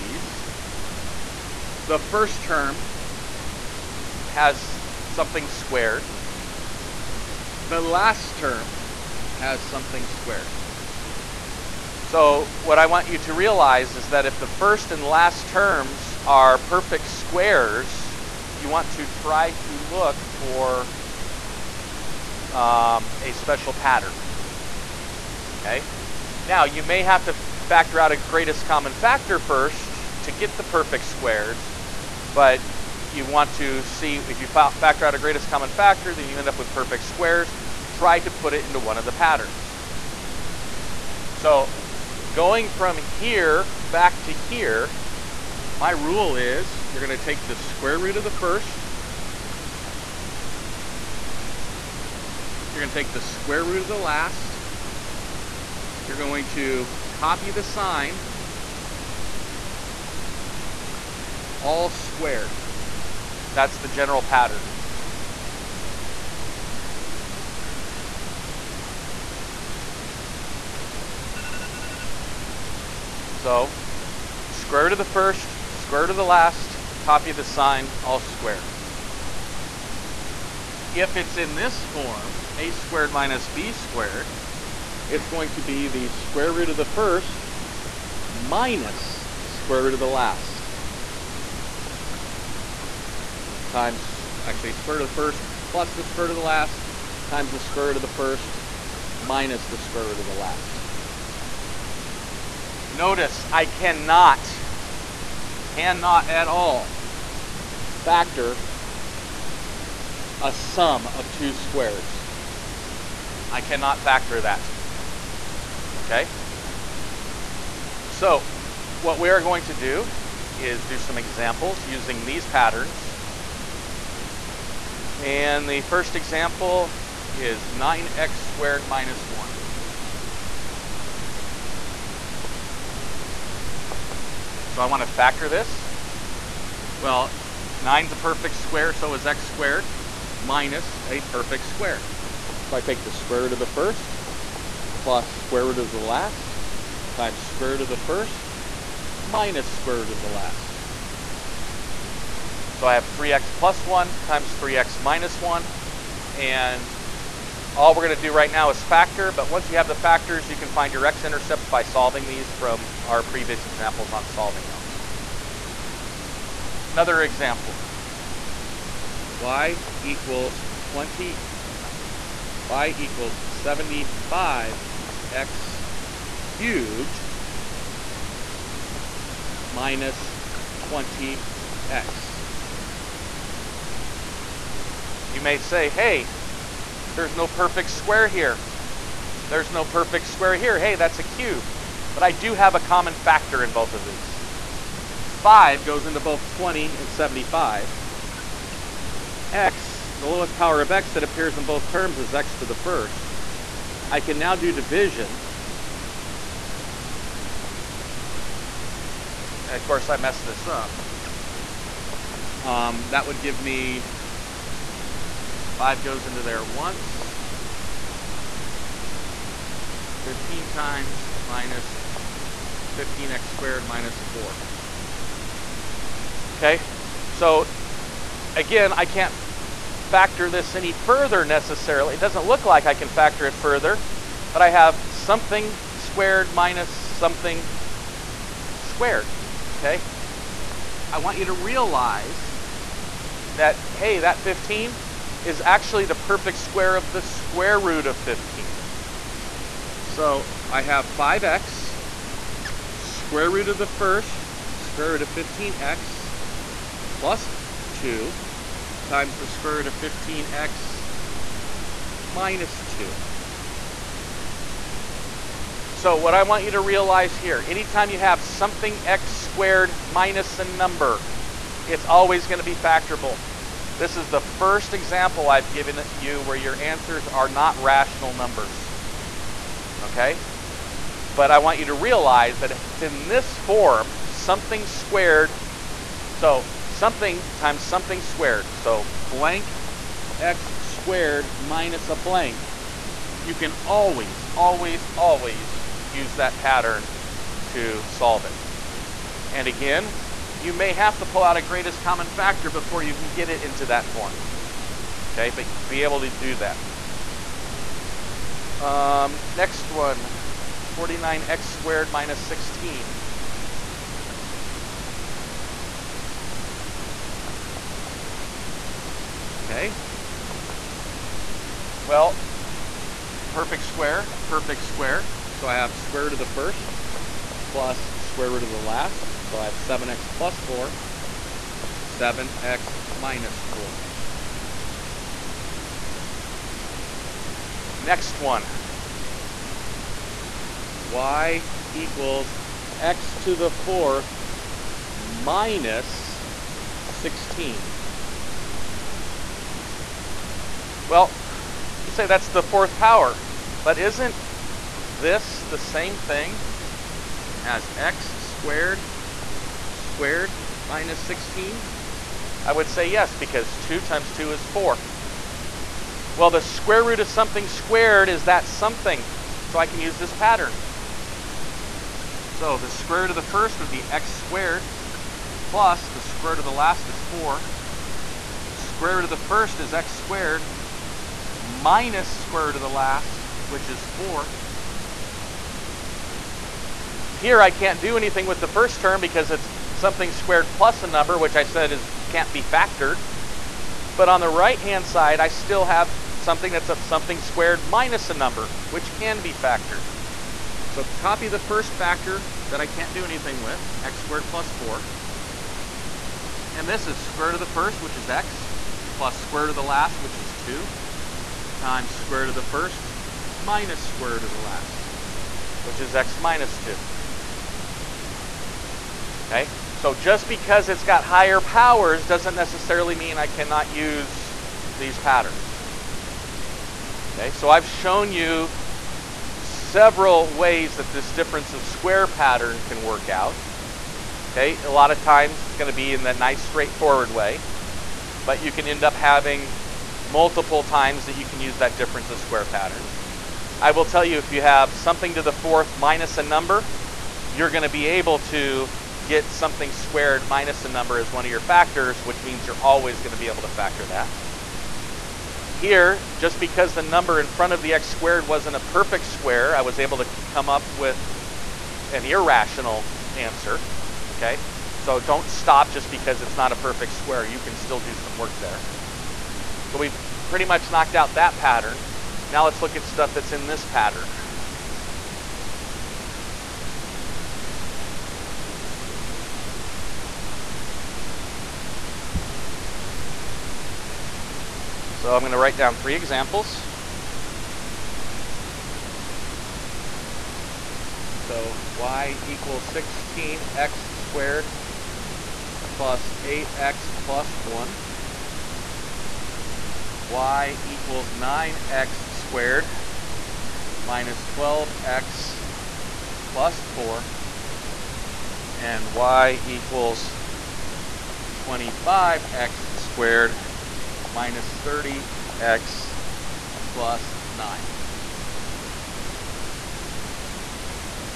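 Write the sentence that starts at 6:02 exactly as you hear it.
I would say yes, because 2 times 2 is 4.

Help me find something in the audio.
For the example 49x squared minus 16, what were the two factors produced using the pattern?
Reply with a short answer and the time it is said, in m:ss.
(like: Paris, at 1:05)
7x + 4 and 7x - 4, at 5:29.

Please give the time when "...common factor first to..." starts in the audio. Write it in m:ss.
0:28.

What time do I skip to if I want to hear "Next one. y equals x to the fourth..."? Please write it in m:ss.
5:37.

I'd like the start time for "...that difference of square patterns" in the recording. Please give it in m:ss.
7:21.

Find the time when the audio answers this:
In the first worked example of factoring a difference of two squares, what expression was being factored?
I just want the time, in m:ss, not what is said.
2:07.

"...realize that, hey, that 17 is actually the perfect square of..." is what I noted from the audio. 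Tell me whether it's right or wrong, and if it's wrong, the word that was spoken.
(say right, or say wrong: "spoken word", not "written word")
wrong: "15", not "17".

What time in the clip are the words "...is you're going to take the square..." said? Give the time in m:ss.
0:46.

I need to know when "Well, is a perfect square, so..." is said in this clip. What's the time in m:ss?
2:16.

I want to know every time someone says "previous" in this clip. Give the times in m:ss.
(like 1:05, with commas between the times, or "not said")
2:43.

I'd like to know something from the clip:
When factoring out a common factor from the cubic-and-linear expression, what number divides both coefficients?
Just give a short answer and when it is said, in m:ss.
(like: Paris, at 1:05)
5, at 3:15.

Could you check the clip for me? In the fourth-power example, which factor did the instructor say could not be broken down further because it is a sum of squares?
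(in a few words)
x^2 + 4.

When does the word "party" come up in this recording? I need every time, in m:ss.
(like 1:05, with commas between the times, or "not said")
not said.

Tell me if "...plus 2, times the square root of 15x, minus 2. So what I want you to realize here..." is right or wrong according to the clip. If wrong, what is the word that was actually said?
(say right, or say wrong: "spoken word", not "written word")
right.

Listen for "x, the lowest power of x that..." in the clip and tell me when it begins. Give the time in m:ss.
3:19.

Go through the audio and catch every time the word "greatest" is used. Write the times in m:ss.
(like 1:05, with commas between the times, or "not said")
0:28, 0:35, 5:01.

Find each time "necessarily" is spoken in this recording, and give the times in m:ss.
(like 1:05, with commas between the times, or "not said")
3:51, 7:02.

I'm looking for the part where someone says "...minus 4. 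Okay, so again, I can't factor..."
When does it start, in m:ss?
3:43.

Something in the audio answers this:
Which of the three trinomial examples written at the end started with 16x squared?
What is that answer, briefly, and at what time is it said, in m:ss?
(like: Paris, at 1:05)
16x^2 + 8x + 1, at 8:12.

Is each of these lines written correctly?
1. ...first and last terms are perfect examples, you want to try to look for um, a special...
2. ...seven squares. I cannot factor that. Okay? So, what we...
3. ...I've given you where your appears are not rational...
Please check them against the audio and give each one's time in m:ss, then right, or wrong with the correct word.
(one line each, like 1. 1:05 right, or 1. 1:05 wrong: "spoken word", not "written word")
1. 0:14 wrong: "squares", not "examples"
2. 1:51 wrong: "two", not "seven"
3. 4:35 wrong: "answers", not "appears".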